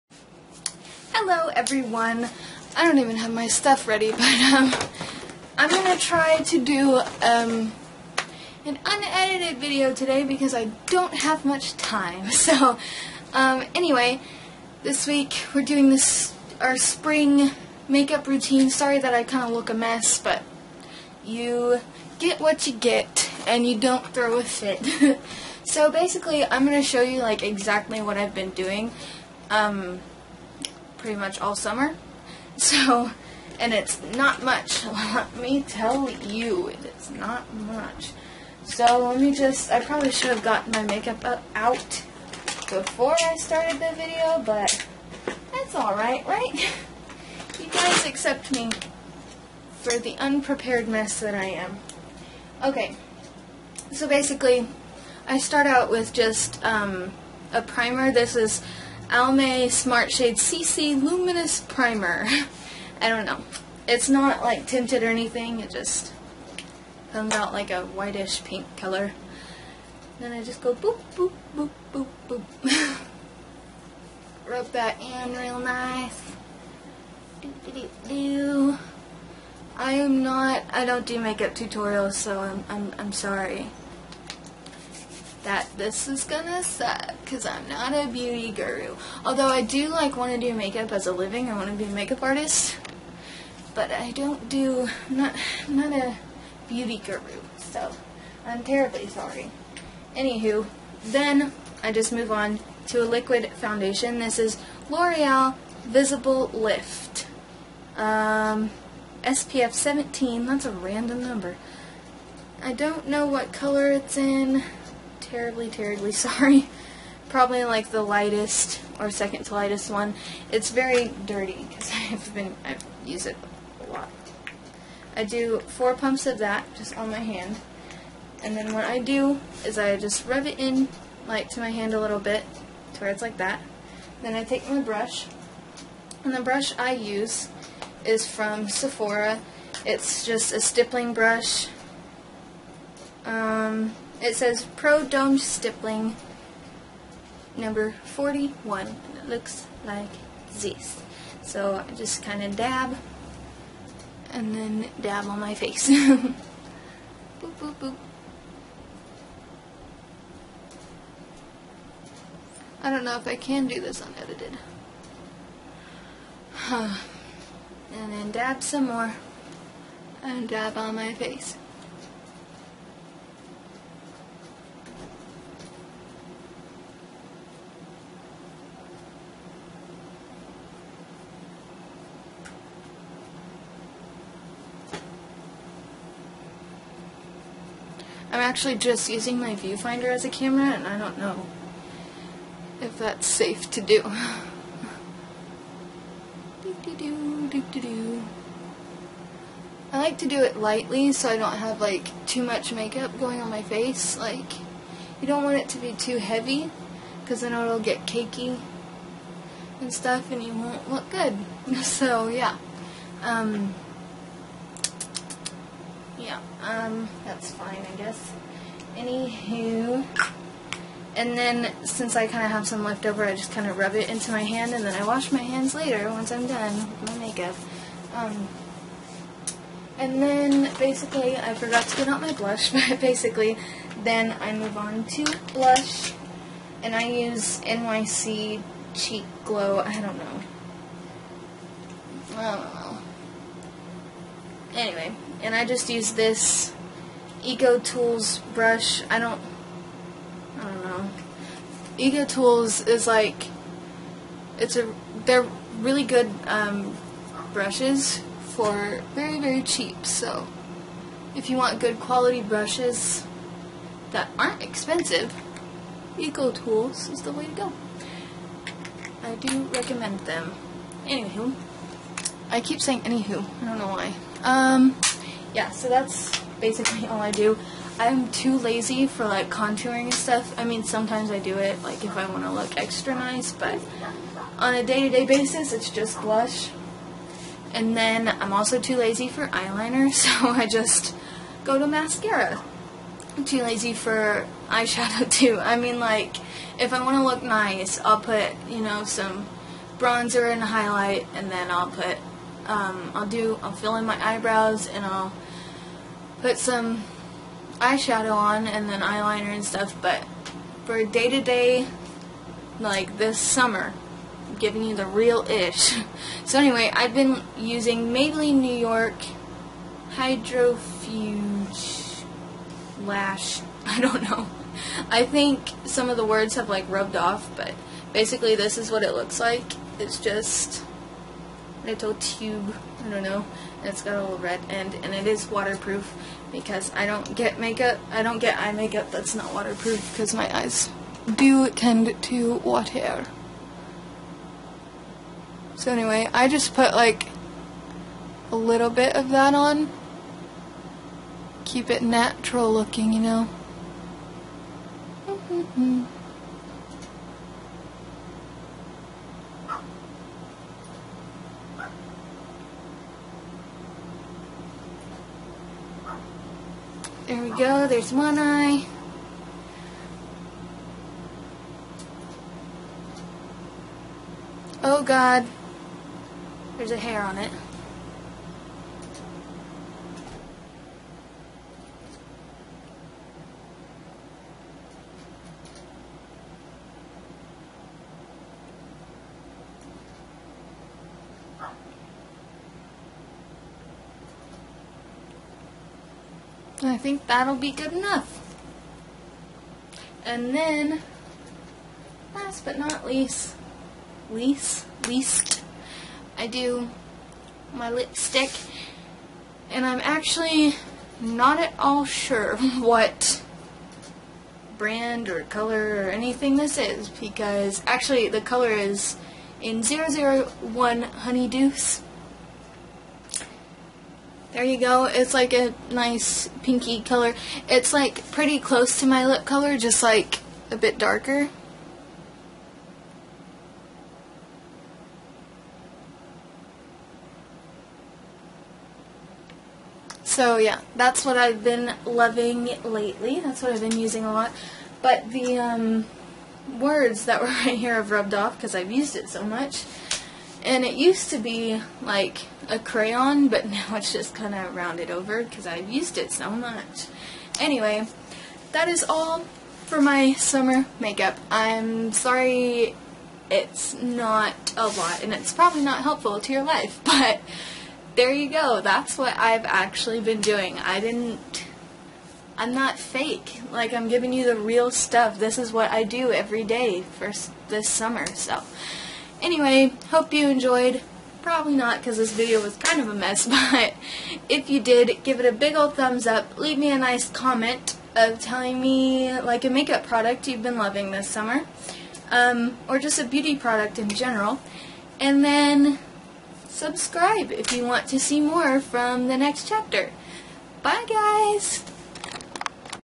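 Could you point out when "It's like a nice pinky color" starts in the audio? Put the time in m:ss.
7:05.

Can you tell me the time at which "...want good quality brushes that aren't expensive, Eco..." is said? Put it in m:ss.
4:21.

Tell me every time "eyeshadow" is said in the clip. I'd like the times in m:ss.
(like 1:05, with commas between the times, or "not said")
4:54, 5:07.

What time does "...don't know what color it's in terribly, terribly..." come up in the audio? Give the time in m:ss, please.
1:52.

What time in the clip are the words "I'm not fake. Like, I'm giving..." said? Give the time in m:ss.
7:52.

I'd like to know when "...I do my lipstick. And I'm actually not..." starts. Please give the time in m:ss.
6:46.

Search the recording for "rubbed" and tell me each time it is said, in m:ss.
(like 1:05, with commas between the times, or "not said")
5:26, 7:28.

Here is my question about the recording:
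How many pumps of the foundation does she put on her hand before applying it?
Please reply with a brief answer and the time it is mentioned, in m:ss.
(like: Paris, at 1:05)
4, at 2:05.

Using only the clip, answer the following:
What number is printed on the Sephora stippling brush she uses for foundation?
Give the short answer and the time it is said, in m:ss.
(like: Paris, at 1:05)
41, at 2:27.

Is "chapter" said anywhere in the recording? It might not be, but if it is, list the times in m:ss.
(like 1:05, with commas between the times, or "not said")
8:19.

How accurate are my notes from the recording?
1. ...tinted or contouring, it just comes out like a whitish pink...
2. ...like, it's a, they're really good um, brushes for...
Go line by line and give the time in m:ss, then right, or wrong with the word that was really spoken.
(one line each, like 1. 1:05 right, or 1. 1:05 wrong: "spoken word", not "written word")
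1. 1:04 wrong: "anything", not "contouring"
2. 4:13 right.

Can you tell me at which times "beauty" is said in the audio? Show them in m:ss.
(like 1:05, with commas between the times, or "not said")
1:28, 1:36, 8:13.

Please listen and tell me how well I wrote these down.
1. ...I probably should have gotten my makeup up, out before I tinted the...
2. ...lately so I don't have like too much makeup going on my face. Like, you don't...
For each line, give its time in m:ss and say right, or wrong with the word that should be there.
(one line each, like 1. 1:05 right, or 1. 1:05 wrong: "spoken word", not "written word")
1. 0:39 wrong: "started", not "tinted"
2. 3:20 wrong: "lightly", not "lately".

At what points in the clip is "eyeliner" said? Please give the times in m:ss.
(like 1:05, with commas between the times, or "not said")
4:49, 5:09.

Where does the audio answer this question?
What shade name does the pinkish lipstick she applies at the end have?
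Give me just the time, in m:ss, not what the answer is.
6:59.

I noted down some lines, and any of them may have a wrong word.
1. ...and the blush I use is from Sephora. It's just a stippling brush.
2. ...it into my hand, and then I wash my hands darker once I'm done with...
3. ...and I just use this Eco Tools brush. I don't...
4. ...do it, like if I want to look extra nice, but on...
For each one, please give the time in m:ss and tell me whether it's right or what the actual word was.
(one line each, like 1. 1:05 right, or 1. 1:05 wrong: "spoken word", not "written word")
1. 2:16 wrong: "brush", not "blush"
2. 3:43 wrong: "later", not "darker"
3. 4:05 right
4. 4:41 right.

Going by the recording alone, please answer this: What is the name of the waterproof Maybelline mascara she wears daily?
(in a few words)
Hydrofuge Lash.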